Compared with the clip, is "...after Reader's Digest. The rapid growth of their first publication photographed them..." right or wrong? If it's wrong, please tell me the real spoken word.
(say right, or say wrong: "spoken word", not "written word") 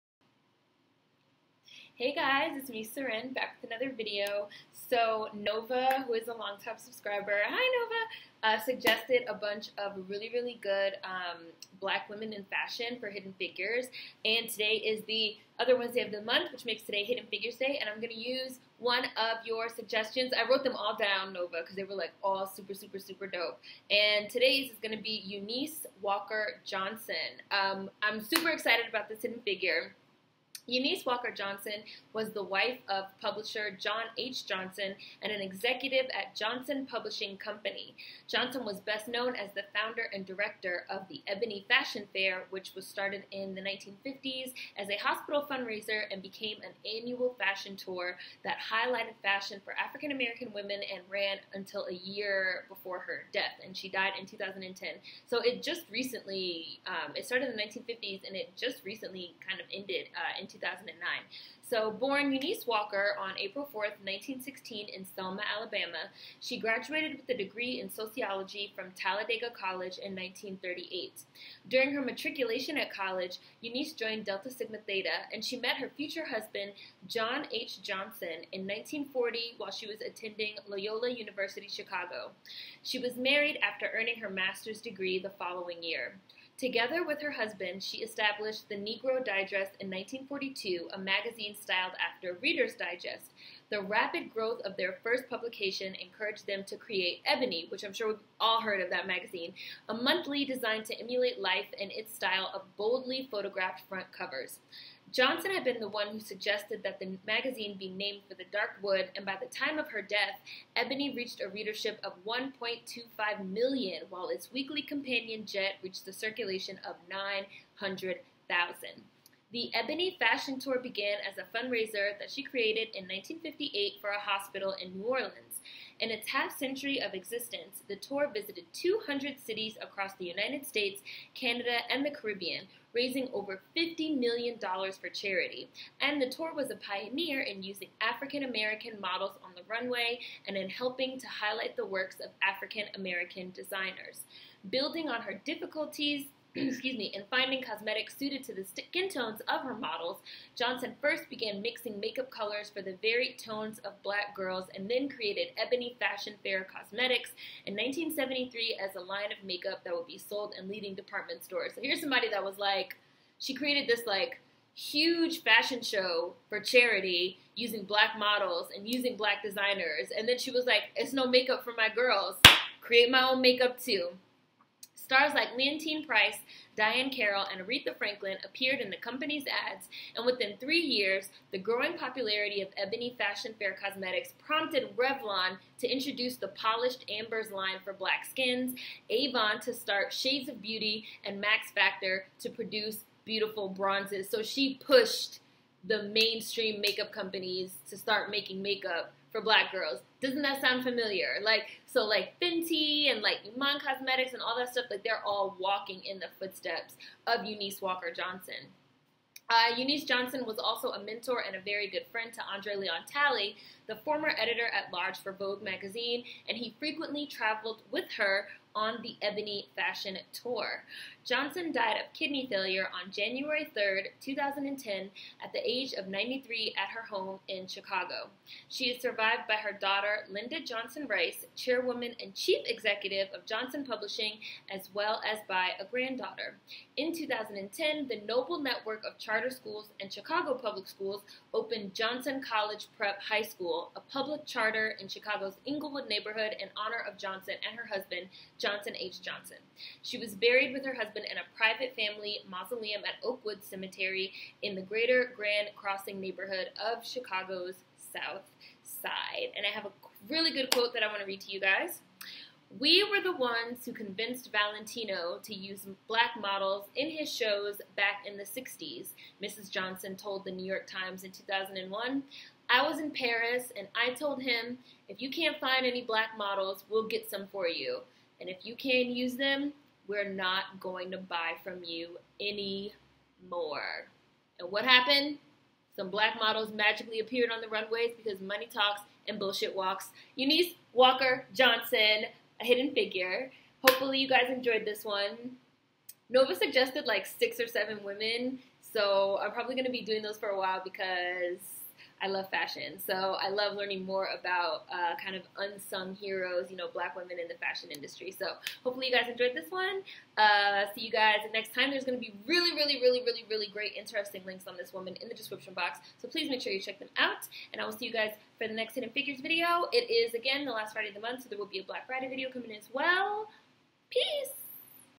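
wrong: "encouraged", not "photographed".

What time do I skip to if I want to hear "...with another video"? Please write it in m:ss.
0:03.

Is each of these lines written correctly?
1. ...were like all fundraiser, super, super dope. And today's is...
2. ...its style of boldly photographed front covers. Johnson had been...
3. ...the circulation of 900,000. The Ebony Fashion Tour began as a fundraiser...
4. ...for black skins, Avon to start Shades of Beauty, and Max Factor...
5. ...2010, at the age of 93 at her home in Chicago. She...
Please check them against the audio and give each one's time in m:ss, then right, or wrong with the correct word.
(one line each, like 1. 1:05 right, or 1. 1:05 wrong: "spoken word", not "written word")
1. 0:21 wrong: "super", not "fundraiser"
2. 1:41 right
3. 1:56 right
4. 3:07 right
5. 3:44 right.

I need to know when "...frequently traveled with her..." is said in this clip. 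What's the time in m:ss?
3:36.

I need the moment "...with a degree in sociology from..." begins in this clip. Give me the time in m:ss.
1:07.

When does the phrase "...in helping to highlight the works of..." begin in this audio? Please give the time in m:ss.
2:20.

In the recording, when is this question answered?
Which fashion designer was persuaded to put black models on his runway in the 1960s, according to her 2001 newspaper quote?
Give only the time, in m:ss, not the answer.
4:24.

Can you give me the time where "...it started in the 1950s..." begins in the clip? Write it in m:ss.
0:57.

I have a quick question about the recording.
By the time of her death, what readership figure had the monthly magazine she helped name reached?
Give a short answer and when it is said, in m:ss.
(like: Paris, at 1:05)
1.25 million, at 1:52.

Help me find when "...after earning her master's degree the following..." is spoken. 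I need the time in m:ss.
1:23.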